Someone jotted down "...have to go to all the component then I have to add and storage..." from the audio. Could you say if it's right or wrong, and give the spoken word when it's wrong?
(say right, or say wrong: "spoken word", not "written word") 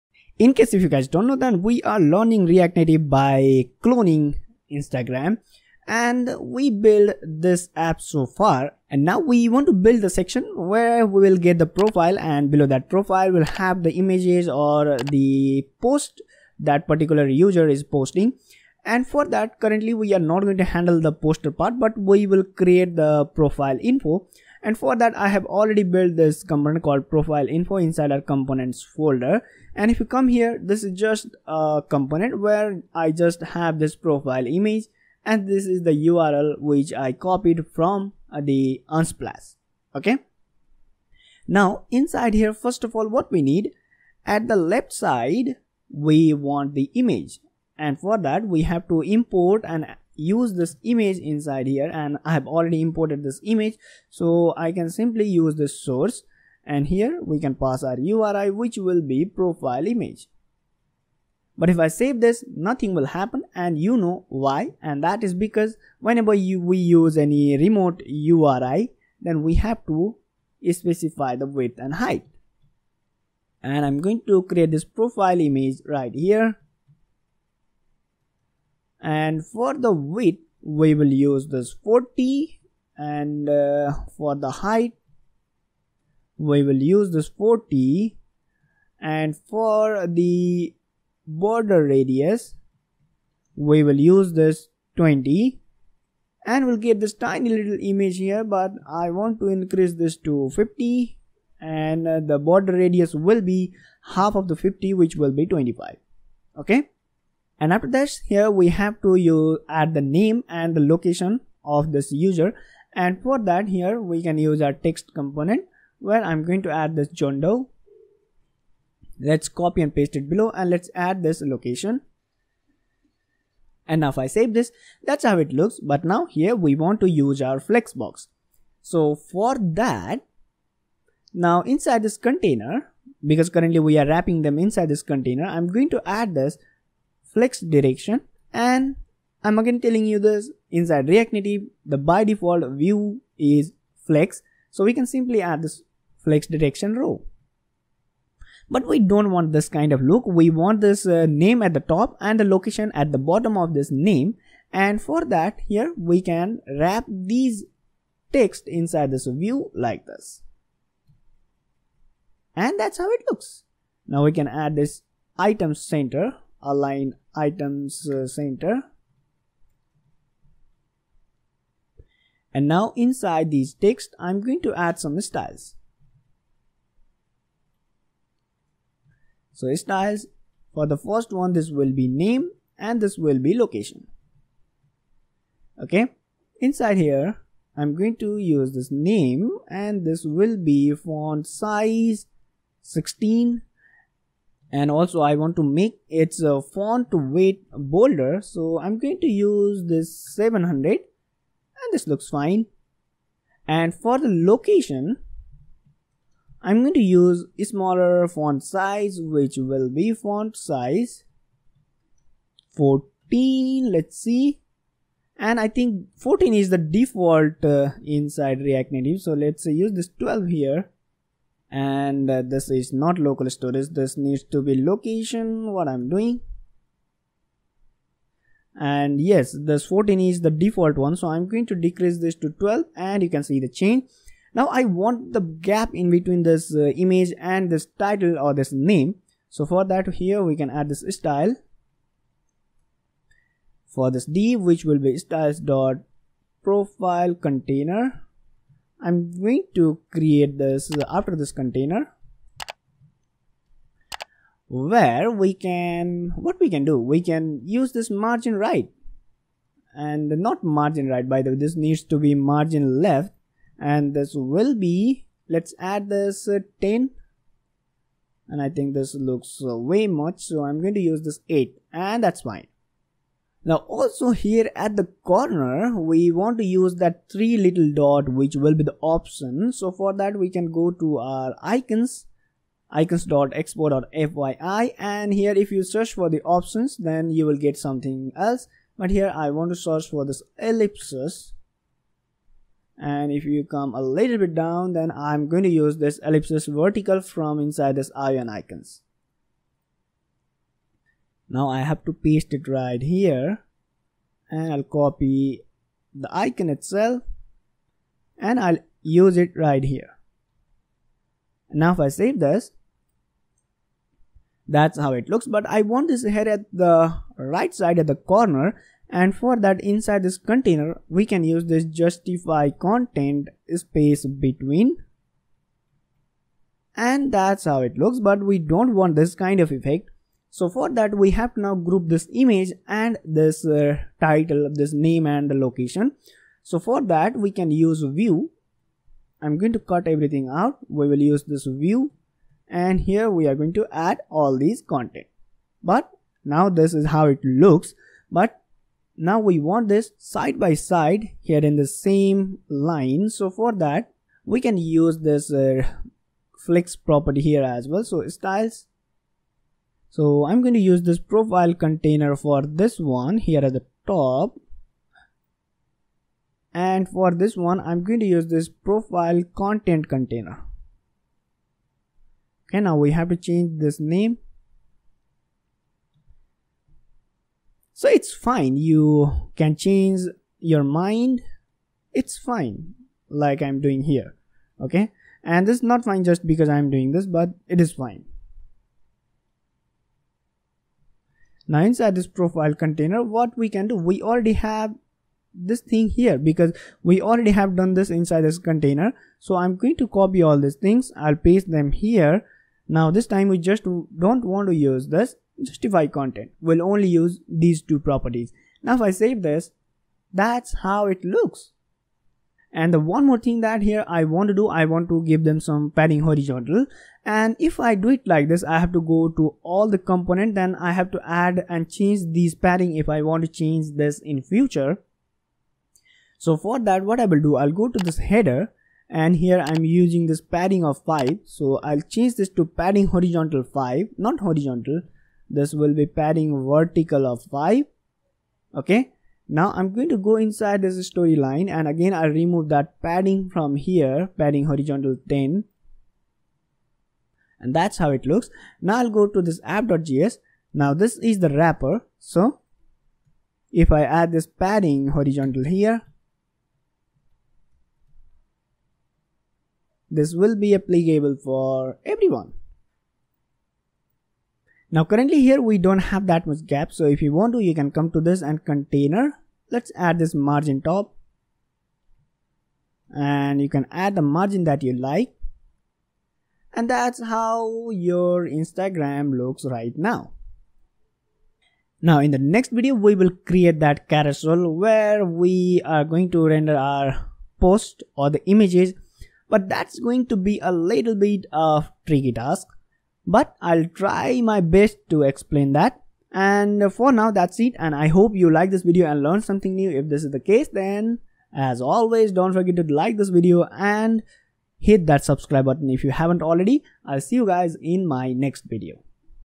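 wrong: "change", not "storage".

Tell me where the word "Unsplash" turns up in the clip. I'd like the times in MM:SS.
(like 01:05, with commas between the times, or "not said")
00:38.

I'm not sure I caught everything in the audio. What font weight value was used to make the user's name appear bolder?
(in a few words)
700.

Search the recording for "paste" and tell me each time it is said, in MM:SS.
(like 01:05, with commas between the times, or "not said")
01:59, 05:02, 06:41.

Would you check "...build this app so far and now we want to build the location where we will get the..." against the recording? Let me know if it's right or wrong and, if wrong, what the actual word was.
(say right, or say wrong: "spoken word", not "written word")
wrong: "section", not "location".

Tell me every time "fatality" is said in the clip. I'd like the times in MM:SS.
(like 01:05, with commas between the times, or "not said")
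not said.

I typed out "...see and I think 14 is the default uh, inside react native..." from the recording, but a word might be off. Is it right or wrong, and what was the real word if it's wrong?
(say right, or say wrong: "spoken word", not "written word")
right.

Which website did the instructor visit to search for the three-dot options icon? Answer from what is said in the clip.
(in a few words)
icons.expo.fyi.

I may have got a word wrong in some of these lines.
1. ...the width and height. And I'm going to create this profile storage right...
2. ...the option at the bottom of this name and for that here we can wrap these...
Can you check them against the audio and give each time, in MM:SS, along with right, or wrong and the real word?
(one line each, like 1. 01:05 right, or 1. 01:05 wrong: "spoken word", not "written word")
1. 01:11 wrong: "image", not "storage"
2. 02:32 wrong: "location", not "option".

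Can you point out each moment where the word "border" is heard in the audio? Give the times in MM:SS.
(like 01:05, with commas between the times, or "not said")
01:31, 01:42.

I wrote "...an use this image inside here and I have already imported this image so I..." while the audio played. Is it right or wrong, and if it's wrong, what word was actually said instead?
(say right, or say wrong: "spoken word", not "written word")
right.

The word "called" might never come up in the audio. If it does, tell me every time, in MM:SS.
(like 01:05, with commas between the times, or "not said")
00:26.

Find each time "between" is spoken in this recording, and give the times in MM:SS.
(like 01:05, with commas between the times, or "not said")
03:56, 05:24.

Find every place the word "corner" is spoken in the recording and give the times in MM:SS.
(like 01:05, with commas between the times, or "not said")
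04:35, 05:18.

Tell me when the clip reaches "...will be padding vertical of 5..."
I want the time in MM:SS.
07:15.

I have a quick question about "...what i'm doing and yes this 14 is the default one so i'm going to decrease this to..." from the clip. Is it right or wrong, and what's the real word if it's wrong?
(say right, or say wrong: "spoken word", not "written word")
right.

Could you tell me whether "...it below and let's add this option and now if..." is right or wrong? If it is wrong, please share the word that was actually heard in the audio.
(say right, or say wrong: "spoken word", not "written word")
wrong: "location", not "option".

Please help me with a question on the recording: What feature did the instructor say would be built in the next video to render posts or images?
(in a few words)
carousel.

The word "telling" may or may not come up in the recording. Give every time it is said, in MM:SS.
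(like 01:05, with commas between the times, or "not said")
02:19.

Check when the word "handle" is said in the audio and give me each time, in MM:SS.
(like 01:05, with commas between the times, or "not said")
00:20.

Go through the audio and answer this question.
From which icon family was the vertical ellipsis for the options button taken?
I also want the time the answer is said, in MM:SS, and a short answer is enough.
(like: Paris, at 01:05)
Ionicons, at 04:58.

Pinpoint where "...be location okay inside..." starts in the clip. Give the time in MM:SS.
03:03.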